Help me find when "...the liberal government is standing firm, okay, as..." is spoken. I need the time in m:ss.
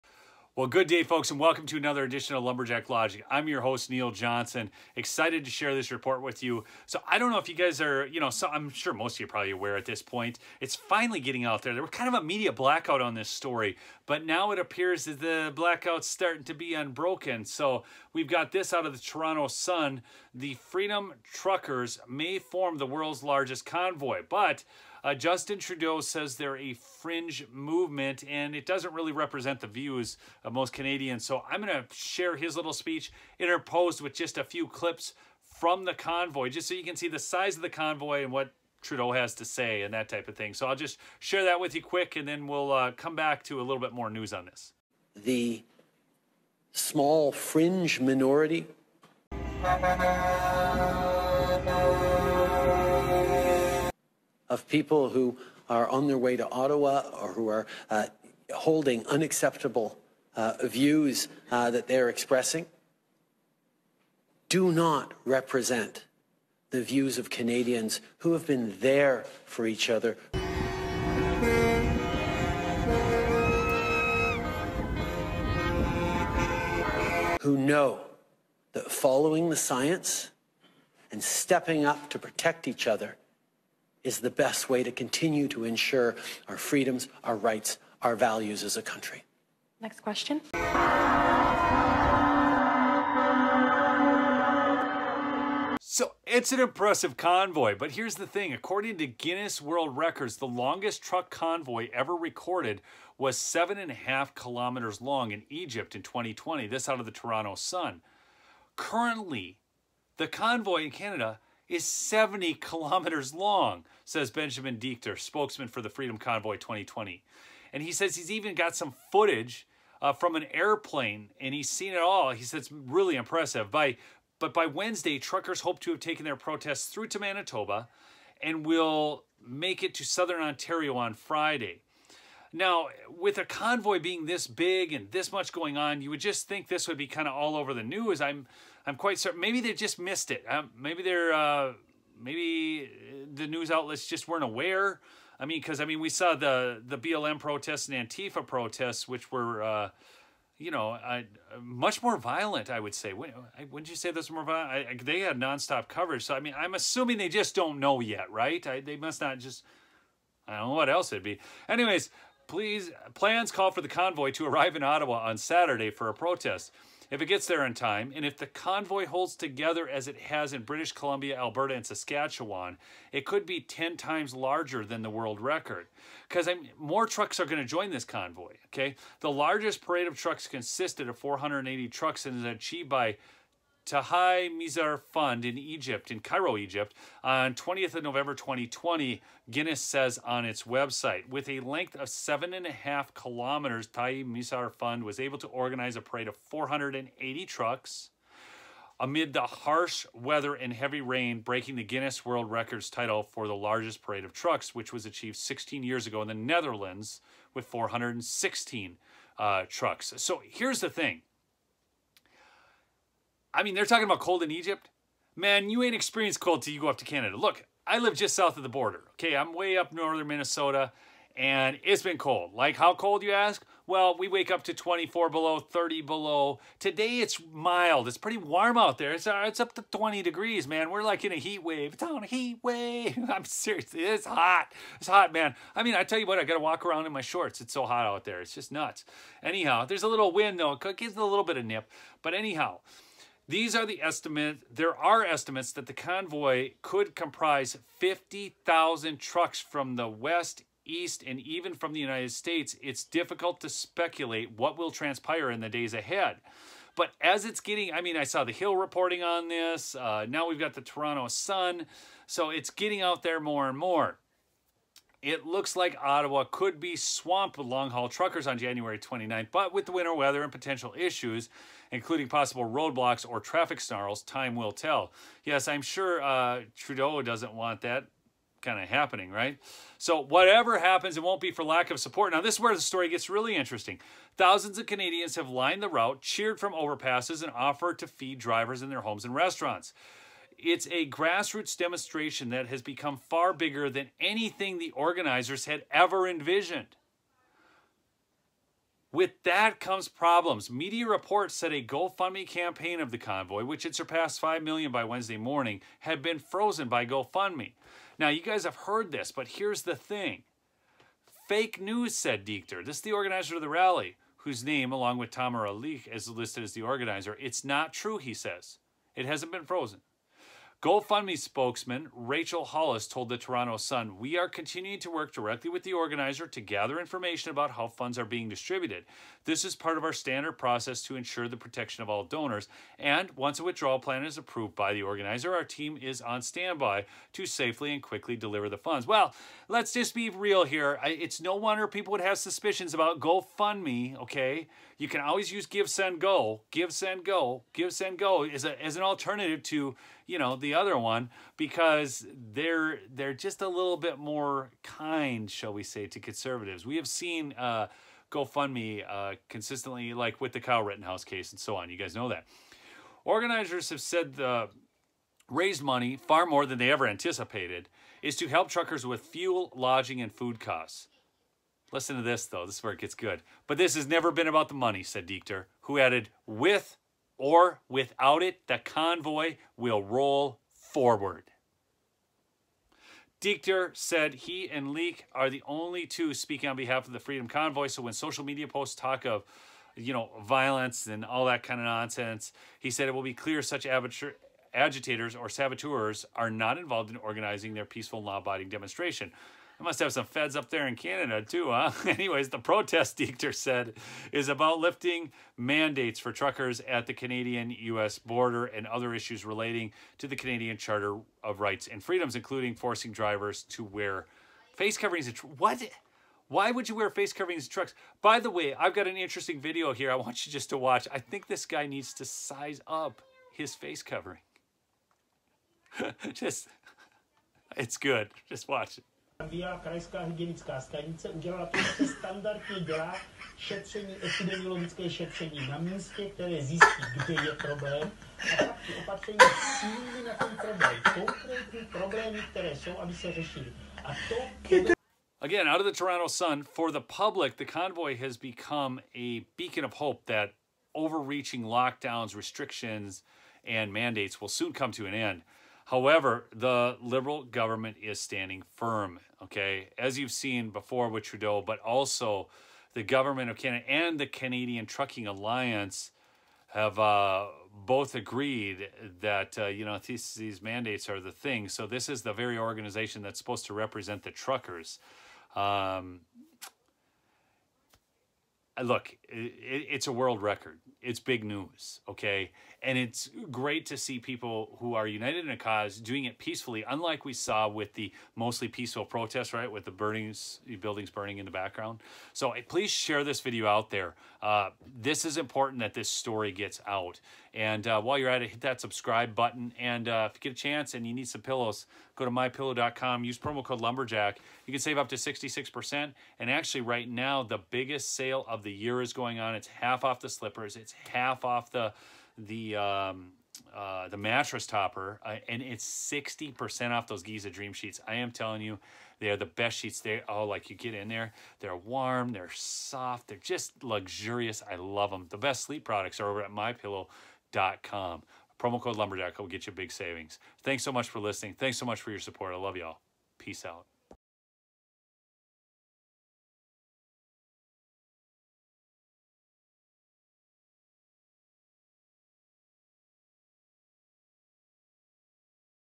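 7:36.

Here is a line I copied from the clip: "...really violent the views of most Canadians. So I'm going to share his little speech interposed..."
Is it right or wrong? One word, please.
wrong.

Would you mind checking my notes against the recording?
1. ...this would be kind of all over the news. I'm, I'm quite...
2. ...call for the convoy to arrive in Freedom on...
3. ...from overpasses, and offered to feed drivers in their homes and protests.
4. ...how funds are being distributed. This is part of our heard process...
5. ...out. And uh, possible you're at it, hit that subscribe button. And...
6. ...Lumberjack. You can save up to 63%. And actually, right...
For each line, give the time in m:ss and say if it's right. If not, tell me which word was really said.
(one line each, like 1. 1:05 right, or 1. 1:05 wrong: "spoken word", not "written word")
1. 2:16 right
2. 2:43 wrong: "Ottawa", not "Freedom"
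3. 4:46 wrong: "restaurants", not "protests"
4. 5:27 wrong: "standard", not "heard"
5. 8:16 wrong: "while", not "possible"
6. 8:23 wrong: "66", not "63".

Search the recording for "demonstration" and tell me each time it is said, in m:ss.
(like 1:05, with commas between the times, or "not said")
4:51, 6:38.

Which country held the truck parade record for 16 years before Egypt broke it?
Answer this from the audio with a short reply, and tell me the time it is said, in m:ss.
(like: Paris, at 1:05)
the Netherlands, at 3:26.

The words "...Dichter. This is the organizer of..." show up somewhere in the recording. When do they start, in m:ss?
5:12.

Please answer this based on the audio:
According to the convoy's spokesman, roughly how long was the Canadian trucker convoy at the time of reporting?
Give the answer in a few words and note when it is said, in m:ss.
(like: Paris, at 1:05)
70 kilometers, at 1:51.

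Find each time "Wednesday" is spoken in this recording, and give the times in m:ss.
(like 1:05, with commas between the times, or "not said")
2:04, 5:05.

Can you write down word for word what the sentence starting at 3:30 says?
So here's the thing I mean, they're talking about cold in Egypt.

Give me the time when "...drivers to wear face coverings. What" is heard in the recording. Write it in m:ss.
6:53.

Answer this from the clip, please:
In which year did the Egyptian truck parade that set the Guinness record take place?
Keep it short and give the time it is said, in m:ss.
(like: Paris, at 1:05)
2020, at 3:07.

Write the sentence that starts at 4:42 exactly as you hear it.
Now, this is where the story gets really interesting.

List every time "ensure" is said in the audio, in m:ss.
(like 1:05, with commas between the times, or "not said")
1:25, 5:31.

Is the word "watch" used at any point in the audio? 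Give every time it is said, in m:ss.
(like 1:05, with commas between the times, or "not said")
7:00, 7:08.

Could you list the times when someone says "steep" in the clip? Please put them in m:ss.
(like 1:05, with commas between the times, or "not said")
not said.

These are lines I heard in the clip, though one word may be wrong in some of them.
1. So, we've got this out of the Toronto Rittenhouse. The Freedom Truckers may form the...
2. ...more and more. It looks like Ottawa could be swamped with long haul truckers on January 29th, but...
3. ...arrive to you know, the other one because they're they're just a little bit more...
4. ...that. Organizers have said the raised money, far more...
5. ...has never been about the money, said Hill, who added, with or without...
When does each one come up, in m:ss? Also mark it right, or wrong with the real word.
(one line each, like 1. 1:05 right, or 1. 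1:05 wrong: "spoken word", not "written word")
1. 0:17 wrong: "Sun", not "Rittenhouse"
2. 4:23 right
3. 5:49 wrong: "alternative", not "arrive"
4. 6:02 right
5. 6:13 wrong: "Dichter", not "Hill".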